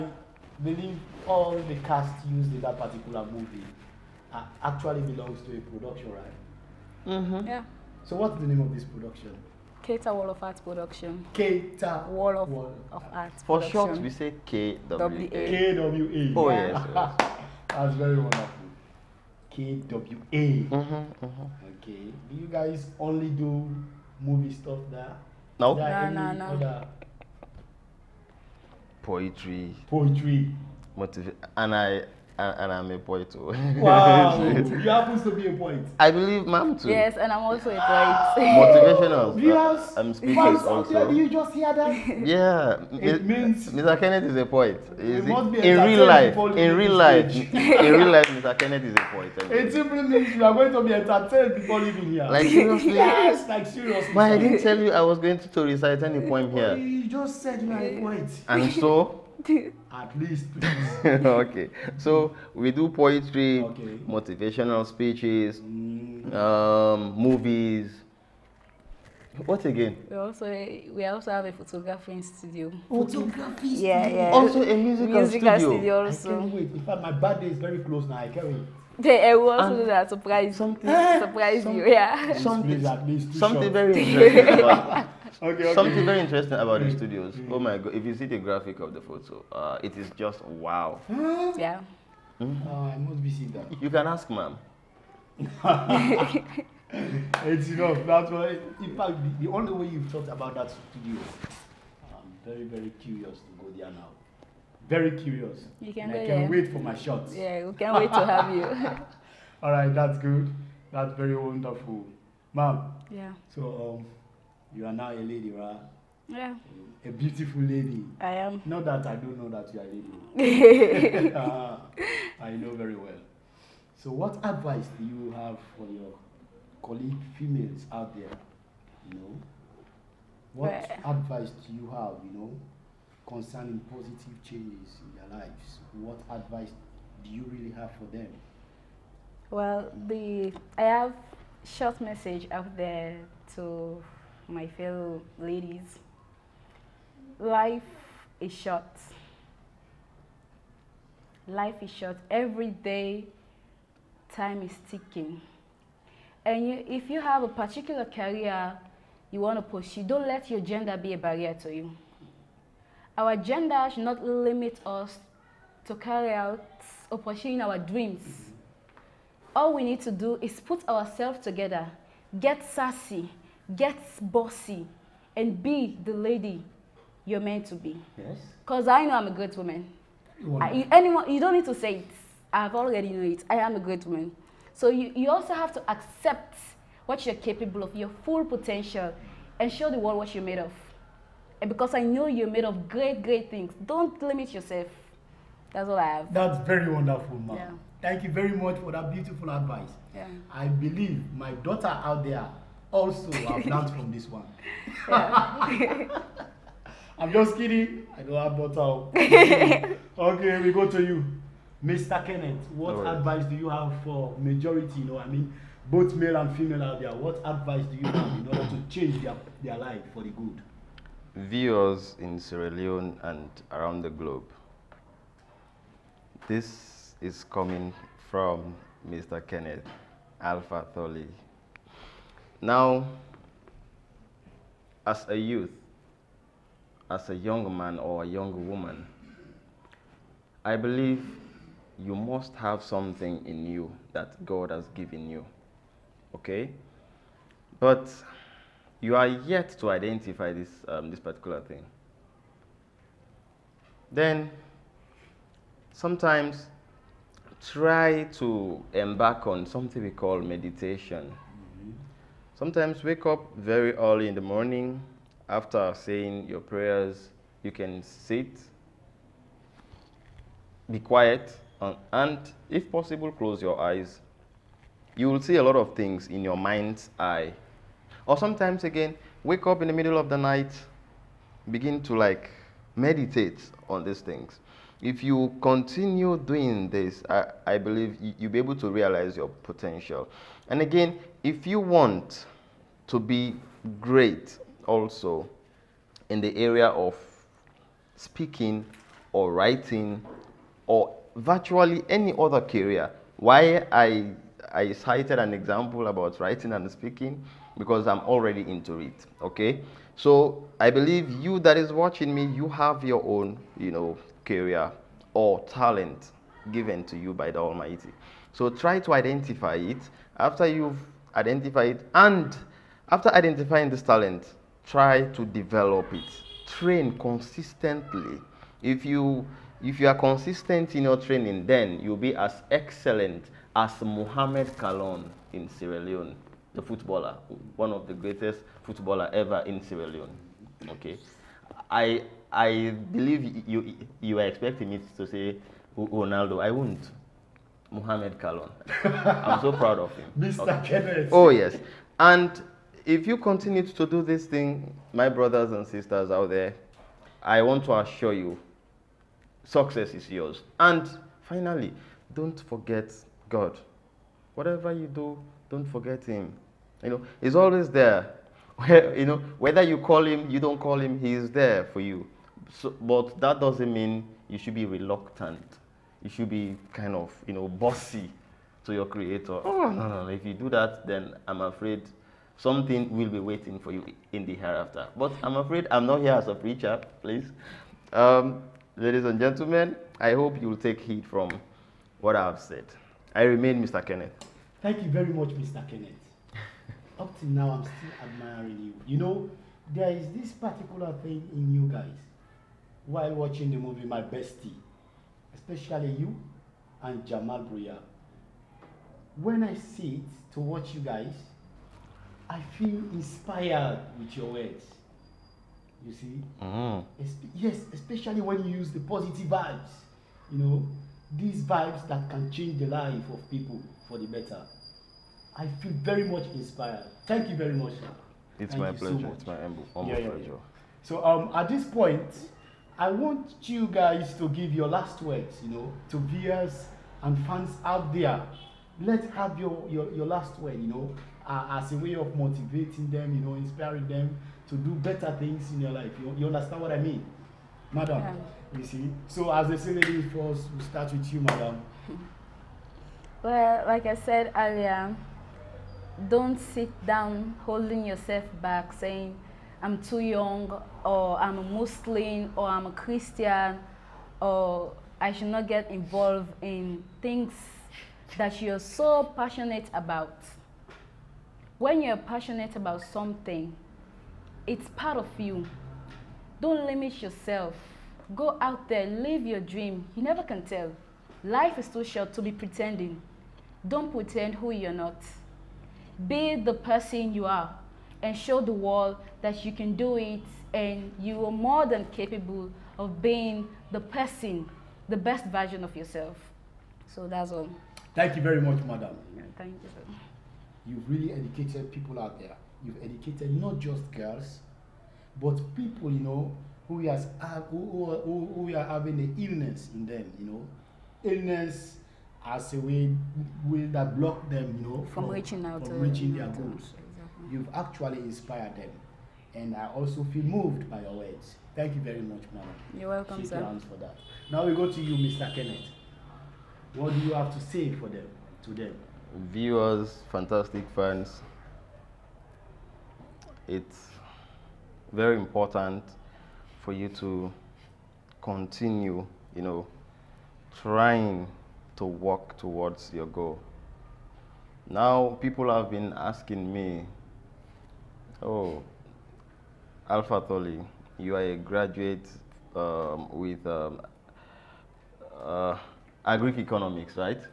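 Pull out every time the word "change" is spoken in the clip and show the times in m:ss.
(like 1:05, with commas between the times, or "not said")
2:14, 3:38, 7:02.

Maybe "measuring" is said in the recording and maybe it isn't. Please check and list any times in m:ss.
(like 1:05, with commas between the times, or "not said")
not said.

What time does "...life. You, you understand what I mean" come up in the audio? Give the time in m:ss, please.
7:25.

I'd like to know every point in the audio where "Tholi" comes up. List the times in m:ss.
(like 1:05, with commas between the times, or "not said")
3:50, 9:10.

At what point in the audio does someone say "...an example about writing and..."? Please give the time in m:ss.
5:05.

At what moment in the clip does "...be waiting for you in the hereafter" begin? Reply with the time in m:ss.
6:23.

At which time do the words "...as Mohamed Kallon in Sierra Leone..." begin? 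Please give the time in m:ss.
5:33.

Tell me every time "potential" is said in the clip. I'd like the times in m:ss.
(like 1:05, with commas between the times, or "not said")
3:08, 4:49.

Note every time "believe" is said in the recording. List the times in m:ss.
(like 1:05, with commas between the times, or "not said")
0:00, 0:36, 3:20, 4:00, 4:47, 5:10, 5:43.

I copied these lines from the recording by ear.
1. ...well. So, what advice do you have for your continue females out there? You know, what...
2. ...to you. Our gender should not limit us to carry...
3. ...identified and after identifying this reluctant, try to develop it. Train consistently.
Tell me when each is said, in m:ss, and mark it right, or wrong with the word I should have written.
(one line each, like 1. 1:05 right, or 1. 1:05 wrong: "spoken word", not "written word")
1. 2:02 wrong: "colleague", not "continue"
2. 2:41 right
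3. 5:21 wrong: "talent", not "reluctant".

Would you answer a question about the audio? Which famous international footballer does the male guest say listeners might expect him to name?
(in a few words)
Ronaldo.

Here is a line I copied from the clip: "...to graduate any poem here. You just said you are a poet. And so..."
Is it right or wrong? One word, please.
wrong.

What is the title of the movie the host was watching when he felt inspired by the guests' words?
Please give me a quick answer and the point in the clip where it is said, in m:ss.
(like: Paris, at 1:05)
My Bestie, at 6:44.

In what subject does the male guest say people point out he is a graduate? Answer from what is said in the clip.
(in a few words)
Economics.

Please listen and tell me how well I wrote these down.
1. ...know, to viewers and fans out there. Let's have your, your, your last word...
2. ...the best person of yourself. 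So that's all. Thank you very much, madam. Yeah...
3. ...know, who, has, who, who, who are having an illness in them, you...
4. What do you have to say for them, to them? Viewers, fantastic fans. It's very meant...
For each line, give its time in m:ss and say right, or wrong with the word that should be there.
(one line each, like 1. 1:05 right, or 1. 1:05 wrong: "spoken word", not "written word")
1. 7:15 right
2. 8:15 wrong: "version", not "person"
3. 8:26 right
4. 8:46 wrong: "important", not "meant".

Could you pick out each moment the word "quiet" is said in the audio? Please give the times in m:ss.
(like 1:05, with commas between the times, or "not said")
4:30.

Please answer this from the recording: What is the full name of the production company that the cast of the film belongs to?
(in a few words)
Keita World of Art Production.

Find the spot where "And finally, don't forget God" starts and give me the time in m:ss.
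6:00.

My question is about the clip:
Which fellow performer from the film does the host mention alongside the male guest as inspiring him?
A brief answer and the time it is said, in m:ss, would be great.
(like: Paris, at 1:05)
Jamal Bruya, at 6:47.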